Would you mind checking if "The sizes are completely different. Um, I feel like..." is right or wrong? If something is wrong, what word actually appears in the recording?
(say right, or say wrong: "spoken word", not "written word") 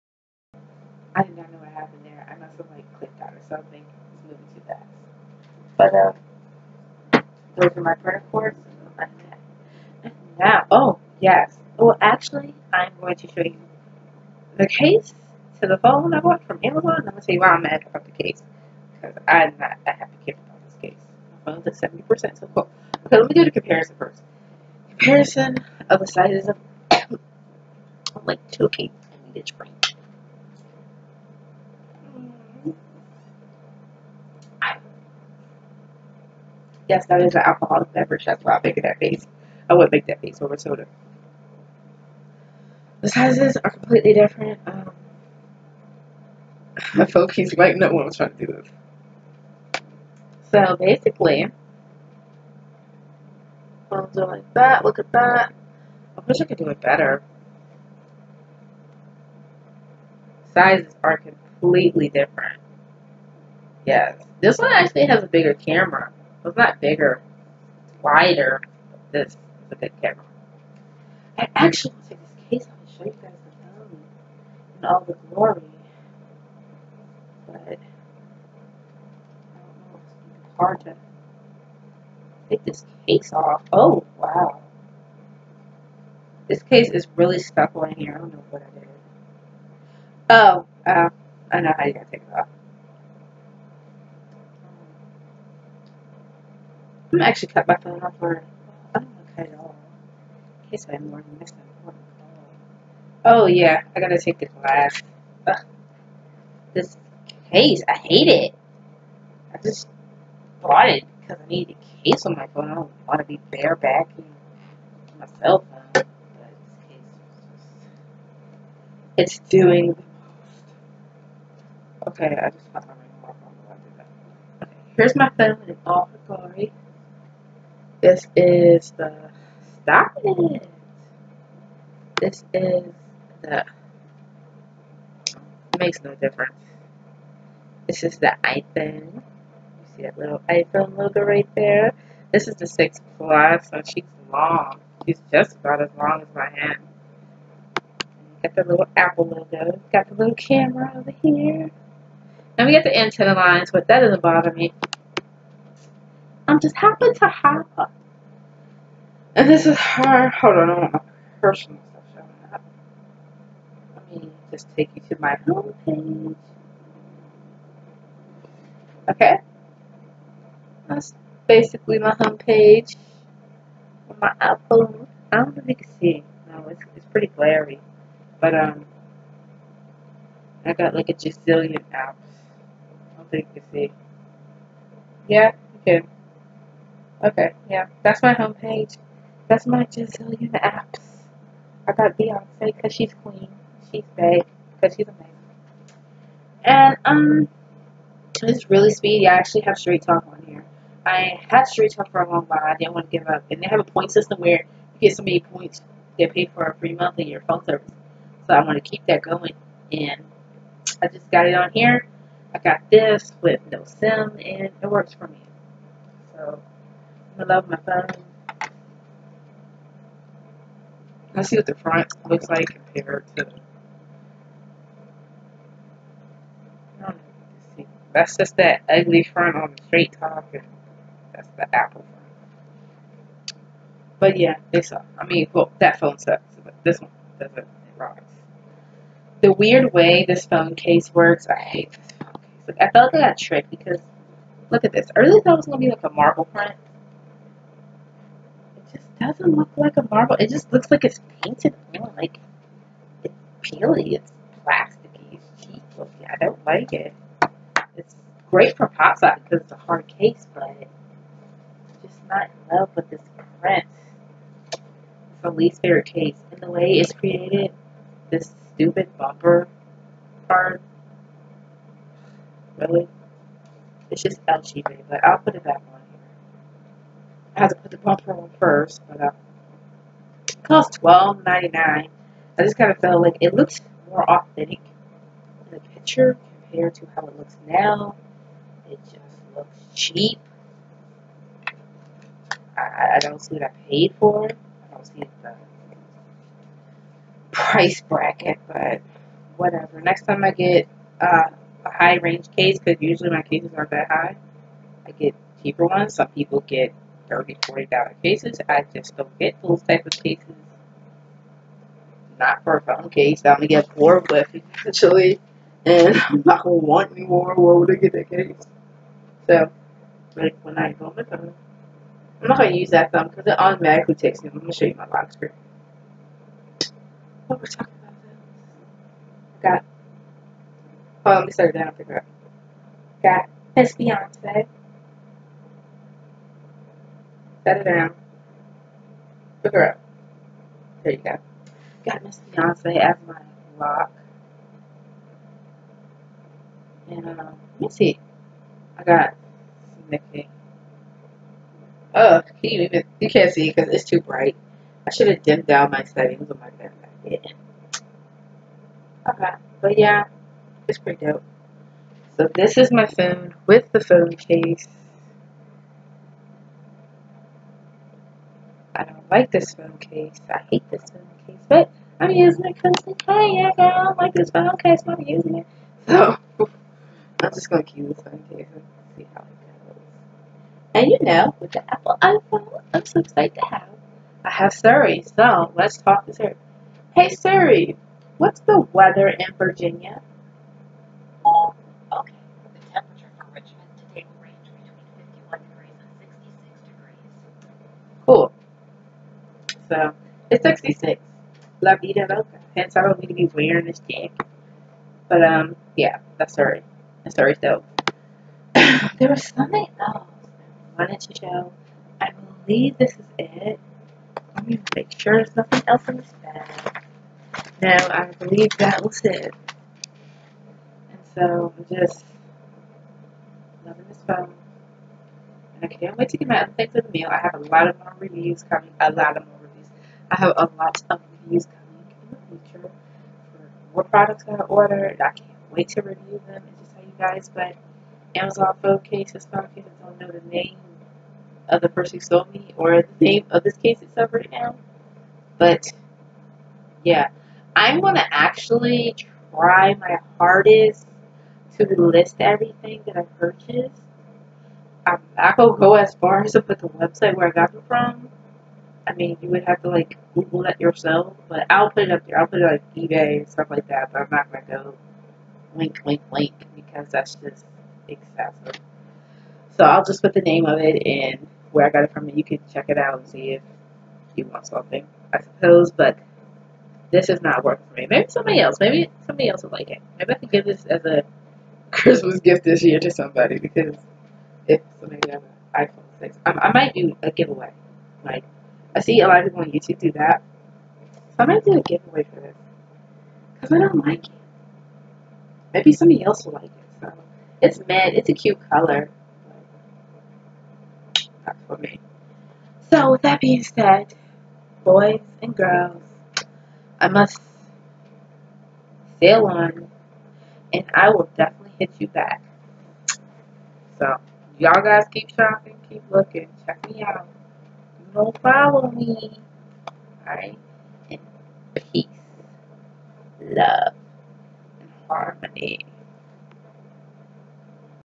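right.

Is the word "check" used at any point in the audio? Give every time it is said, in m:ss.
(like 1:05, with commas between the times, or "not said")
7:52, 8:36.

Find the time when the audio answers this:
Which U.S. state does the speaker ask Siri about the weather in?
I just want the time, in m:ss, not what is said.
6:29.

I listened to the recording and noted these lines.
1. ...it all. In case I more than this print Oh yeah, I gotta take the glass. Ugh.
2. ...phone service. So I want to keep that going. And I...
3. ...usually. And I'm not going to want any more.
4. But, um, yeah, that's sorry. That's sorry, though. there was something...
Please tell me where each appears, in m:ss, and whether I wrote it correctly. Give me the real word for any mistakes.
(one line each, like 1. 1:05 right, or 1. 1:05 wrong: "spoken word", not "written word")
1. 1:39 wrong: "important", not "print"
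2. 3:27 right
3. 5:14 wrong: "eventually", not "usually"
4. 6:45 right.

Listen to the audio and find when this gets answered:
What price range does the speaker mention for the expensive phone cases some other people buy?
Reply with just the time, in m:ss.
5:07.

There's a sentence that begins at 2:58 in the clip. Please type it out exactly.
But, um, I got like a gazillion apps.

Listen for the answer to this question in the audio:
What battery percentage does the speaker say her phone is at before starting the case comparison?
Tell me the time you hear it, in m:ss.
0:21.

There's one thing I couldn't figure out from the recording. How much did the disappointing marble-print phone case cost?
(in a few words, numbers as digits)
$12.99.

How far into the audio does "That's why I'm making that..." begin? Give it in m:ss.
0:38.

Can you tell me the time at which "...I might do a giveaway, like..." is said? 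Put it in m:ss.
8:06.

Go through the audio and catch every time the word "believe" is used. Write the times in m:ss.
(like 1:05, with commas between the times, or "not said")
6:52, 6:58.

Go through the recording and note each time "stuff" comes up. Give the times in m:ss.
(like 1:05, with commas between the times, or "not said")
2:41, 7:43.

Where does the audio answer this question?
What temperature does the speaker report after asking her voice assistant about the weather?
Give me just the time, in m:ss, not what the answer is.
6:40.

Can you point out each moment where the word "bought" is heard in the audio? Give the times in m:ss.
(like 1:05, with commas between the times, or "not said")
0:16, 1:50.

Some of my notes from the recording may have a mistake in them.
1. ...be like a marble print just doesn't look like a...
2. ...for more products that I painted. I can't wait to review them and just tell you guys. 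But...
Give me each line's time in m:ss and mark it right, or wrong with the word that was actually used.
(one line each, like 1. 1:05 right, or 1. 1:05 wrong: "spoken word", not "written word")
1. 4:05 right
2. 7:13 wrong: "ordered", not "painted".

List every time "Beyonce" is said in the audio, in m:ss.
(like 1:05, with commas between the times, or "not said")
3:12, 5:33, 5:42.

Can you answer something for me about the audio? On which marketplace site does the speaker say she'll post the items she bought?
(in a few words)
eBay.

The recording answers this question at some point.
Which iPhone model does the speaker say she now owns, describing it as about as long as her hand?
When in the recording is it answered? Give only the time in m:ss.
2:22.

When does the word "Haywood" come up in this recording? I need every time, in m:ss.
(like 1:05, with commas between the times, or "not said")
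not said.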